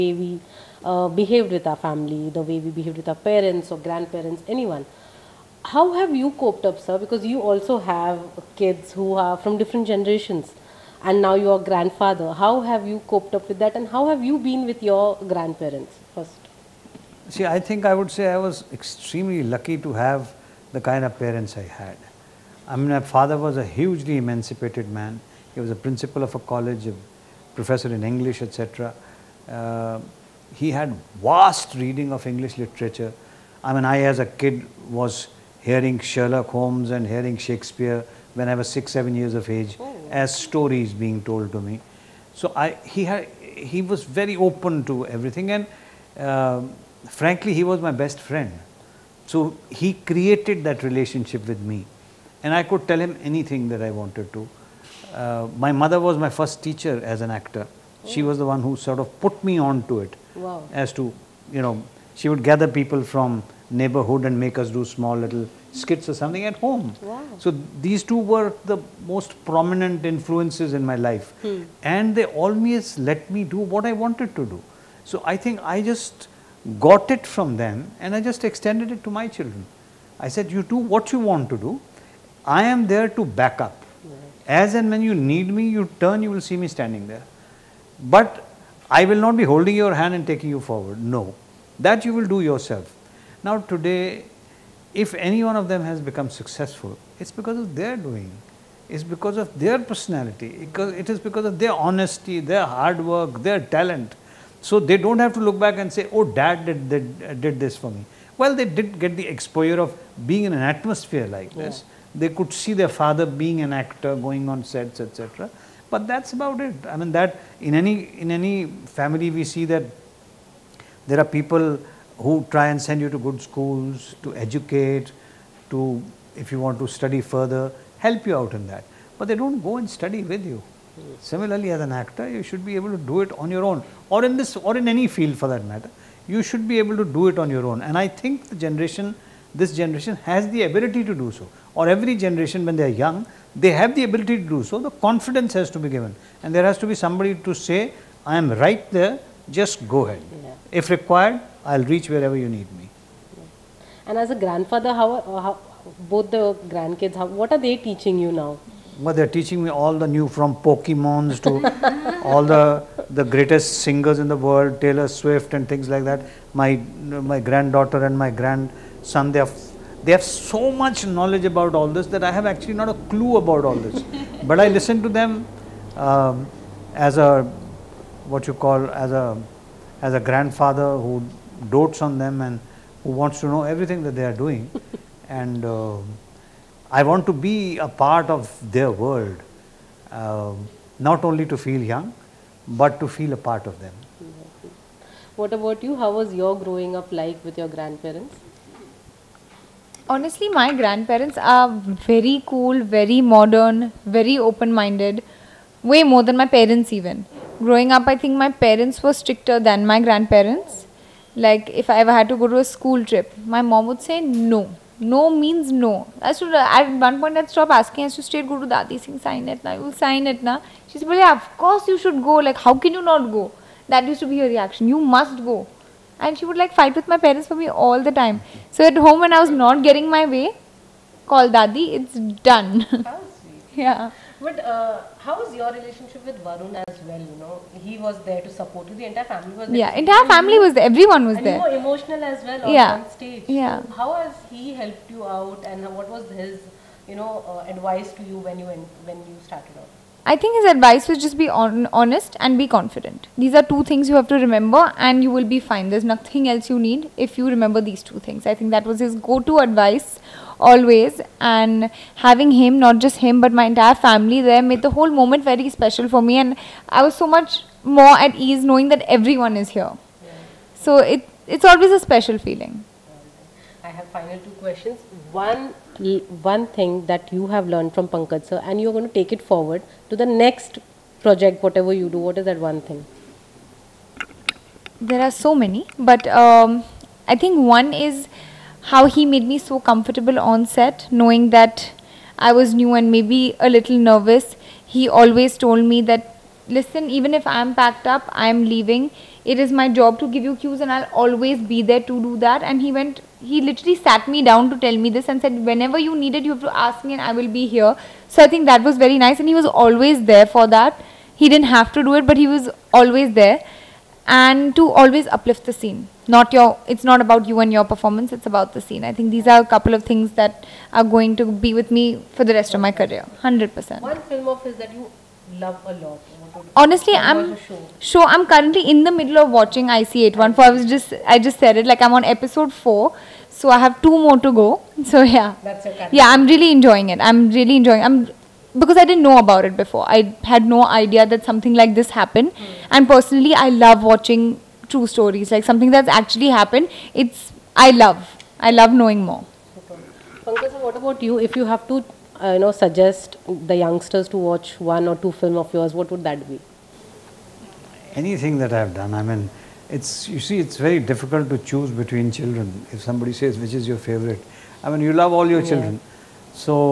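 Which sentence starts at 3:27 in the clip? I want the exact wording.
Growing up, I think my parents were stricter than my grandparents.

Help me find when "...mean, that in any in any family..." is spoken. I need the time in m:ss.
1:56.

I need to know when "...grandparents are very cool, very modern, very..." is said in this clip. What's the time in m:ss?
3:20.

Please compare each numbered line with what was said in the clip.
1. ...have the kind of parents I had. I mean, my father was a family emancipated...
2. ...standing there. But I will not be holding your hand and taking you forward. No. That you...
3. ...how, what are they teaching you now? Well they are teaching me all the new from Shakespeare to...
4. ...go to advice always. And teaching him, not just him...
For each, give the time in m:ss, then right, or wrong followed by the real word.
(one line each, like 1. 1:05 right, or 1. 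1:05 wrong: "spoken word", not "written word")
1. 0:19 wrong: "hugely", not "family"
2. 1:26 right
3. 2:37 wrong: "Pokemons", not "Shakespeare"
4. 4:19 wrong: "having", not "teaching".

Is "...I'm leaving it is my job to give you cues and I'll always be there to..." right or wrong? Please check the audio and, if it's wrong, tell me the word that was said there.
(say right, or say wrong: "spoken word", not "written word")
right.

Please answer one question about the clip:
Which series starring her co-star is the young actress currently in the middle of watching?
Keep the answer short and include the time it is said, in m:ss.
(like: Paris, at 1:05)
IC814, at 5:29.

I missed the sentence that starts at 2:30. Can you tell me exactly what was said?
if required I will reach wherever you need me.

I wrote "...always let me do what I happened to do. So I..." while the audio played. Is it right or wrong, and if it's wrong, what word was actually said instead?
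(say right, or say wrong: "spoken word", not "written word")
wrong: "wanted", not "happened".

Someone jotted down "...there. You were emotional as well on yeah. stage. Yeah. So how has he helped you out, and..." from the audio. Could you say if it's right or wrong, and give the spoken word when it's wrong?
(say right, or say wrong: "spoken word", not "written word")
right.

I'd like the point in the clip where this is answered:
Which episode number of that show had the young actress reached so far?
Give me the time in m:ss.
5:32.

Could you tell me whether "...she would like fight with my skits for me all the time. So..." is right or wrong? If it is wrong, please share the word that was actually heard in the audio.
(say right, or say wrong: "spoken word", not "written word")
wrong: "parents", not "skits".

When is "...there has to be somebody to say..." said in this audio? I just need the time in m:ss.
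2:26.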